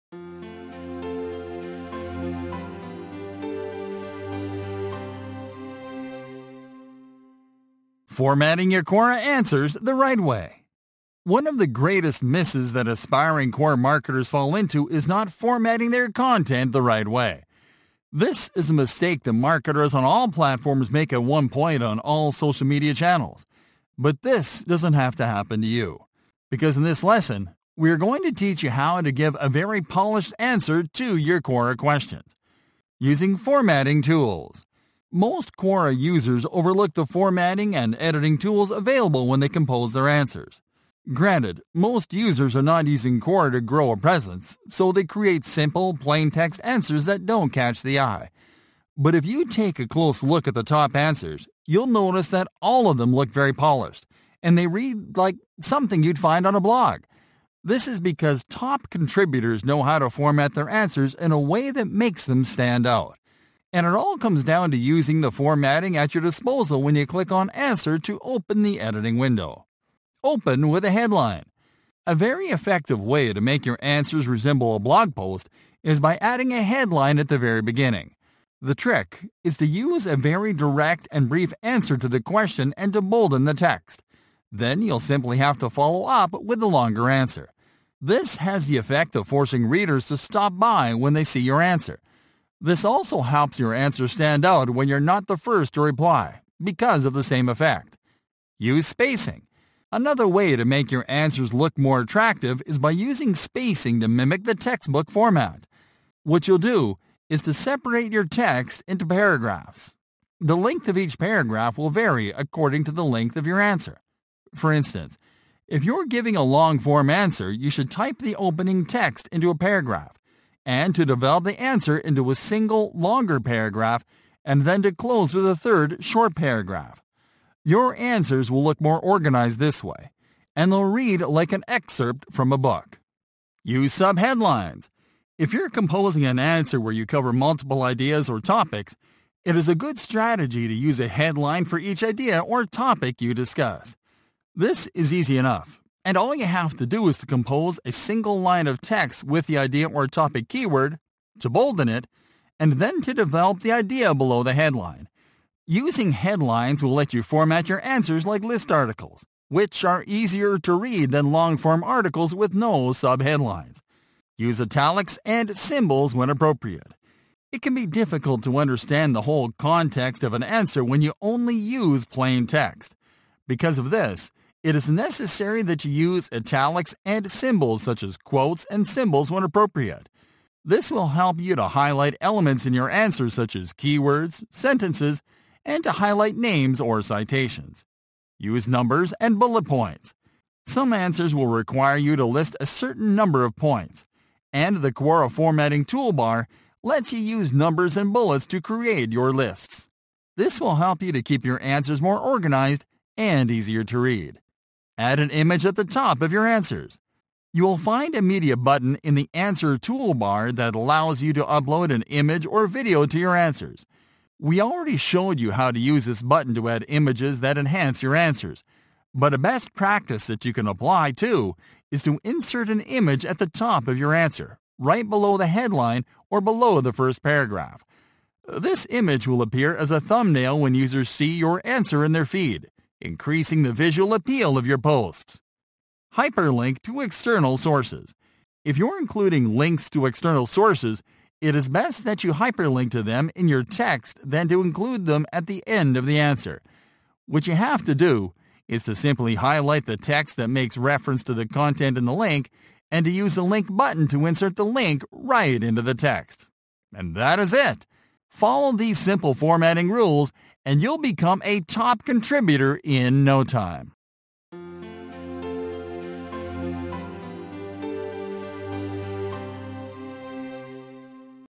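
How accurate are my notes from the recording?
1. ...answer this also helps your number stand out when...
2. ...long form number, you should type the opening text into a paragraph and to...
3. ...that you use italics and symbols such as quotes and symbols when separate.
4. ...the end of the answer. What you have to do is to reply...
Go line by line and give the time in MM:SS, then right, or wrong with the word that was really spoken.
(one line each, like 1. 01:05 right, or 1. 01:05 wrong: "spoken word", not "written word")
1. 01:31 wrong: "answer", not "number"
2. 01:56 wrong: "answer", not "number"
3. 02:55 wrong: "appropriate", not "separate"
4. 04:05 wrong: "simply", not "reply".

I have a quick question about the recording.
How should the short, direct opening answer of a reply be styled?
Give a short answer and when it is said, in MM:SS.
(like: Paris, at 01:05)
bolden the text, at 01:23.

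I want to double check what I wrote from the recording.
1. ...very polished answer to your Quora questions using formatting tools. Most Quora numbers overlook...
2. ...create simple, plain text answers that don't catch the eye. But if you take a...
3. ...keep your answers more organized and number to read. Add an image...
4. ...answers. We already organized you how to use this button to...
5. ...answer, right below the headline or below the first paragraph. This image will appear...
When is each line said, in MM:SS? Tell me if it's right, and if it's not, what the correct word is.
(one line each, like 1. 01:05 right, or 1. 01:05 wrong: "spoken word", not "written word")
1. 00:29 wrong: "users", not "numbers"
2. 00:45 right
3. 03:21 wrong: "easier", not "number"
4. 03:33 wrong: "showed", not "organized"
5. 03:44 right.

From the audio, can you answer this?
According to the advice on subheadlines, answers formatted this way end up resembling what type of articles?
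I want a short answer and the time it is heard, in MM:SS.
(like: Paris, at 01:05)
list articles, at 02:38.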